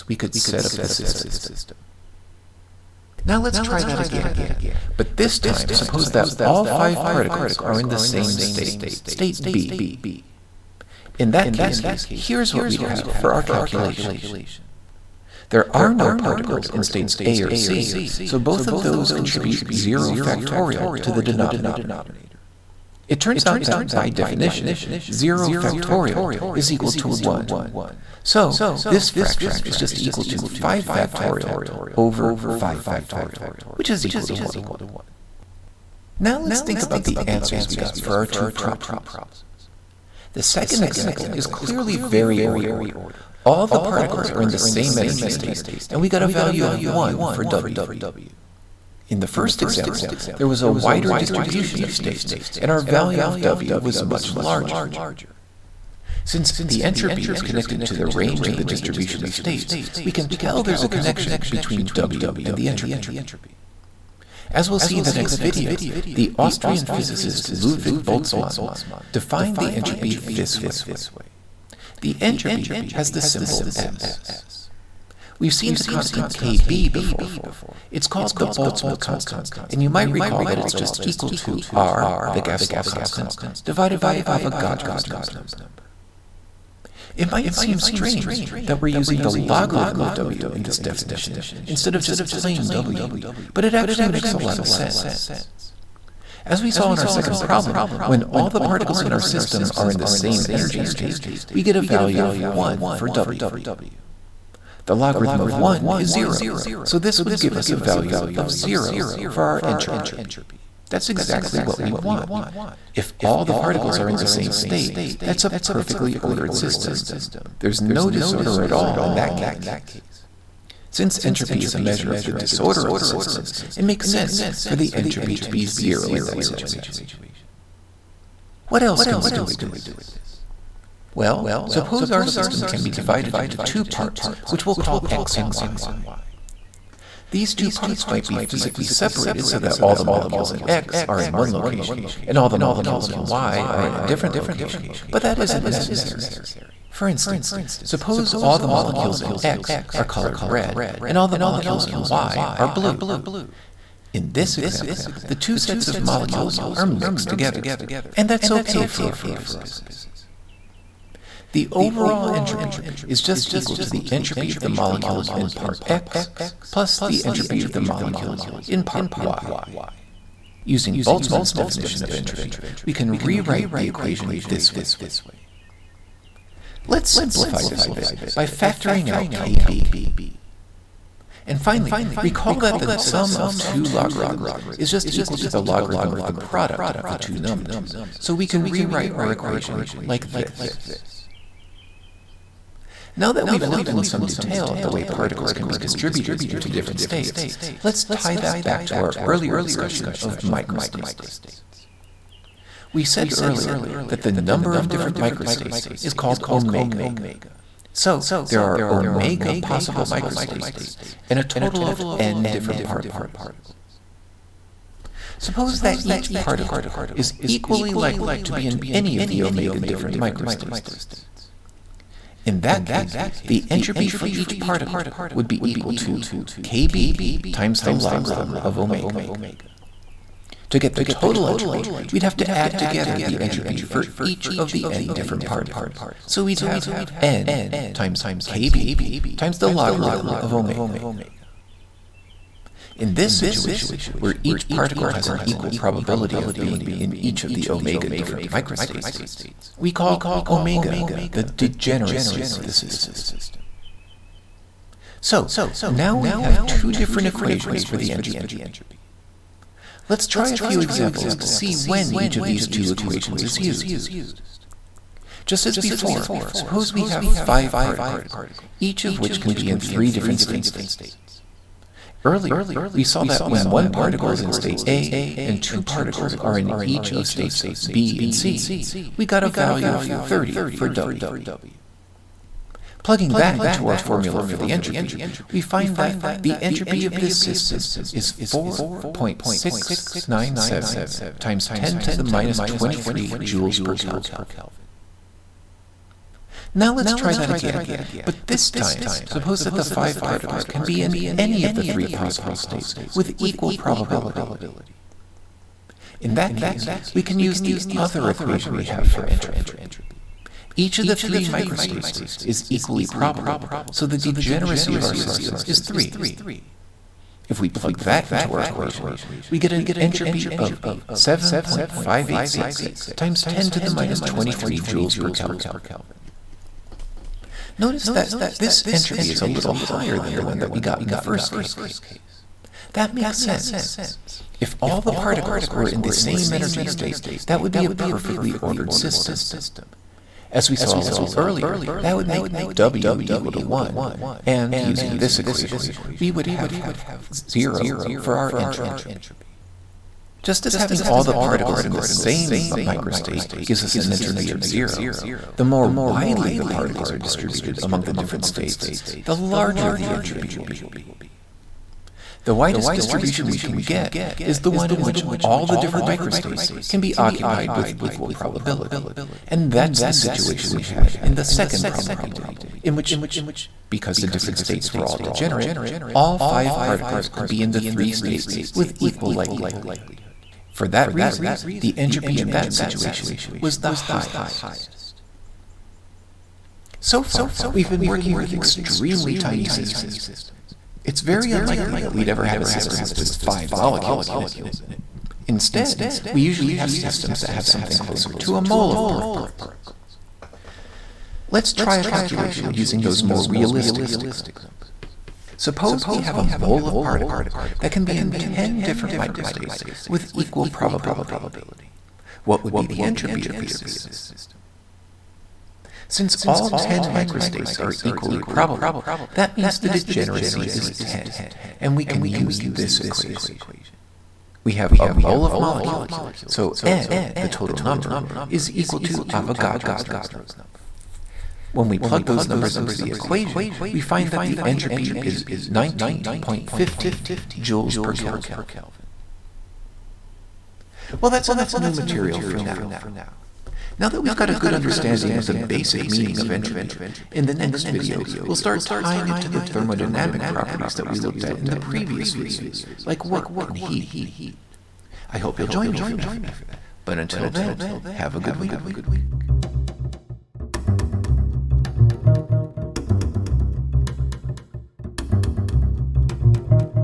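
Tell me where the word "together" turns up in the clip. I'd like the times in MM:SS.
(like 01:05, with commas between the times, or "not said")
02:37, 03:52.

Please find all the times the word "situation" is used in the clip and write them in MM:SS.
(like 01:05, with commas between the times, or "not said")
02:06, 04:03, 06:10, 06:22.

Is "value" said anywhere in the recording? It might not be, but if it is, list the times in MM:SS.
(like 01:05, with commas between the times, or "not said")
00:46, 00:52, 01:41, 01:47, 04:39.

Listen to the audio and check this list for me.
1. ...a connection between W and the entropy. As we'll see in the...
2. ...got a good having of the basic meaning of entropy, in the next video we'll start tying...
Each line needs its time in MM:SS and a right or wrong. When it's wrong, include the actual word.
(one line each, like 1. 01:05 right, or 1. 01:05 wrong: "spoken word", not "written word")
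1. 01:00 right
2. 07:24 wrong: "understanding", not "having".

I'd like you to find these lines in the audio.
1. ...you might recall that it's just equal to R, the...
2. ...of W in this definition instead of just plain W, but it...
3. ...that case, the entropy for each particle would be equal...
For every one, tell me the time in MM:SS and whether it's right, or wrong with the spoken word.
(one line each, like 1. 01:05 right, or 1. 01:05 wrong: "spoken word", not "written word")
1. 01:19 right
2. 01:29 right
3. 03:42 right.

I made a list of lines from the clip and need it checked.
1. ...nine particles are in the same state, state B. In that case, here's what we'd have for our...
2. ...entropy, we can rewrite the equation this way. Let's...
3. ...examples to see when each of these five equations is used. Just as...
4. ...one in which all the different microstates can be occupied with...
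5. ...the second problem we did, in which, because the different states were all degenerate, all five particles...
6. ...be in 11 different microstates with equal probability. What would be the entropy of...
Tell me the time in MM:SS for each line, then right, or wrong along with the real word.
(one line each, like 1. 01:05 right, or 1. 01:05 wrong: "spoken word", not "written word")
1. 00:06 wrong: "five", not "nine"
2. 02:52 right
3. 04:20 wrong: "two", not "five"
4. 06:04 right
5. 06:11 right
6. 06:48 wrong: "10", not "11".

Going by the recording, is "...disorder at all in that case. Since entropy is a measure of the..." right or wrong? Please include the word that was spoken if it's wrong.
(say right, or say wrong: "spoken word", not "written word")
right.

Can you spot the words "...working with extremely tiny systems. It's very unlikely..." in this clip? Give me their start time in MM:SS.
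06:28.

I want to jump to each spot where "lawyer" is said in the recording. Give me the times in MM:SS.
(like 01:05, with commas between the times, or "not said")
not said.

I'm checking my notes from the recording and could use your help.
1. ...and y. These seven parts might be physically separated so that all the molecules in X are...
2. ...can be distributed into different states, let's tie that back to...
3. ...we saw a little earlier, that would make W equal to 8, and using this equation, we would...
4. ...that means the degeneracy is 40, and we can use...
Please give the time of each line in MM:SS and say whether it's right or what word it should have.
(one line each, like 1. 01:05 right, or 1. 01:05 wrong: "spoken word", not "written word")
1. 02:15 wrong: "two", not "seven"
2. 03:15 right
3. 05:40 wrong: "1", not "8"
4. 06:59 wrong: "10", not "40".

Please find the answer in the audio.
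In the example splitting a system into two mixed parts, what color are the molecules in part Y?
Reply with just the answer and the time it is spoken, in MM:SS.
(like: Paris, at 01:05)
blue, at 02:32.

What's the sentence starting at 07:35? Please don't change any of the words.
I hope you'll join me for that.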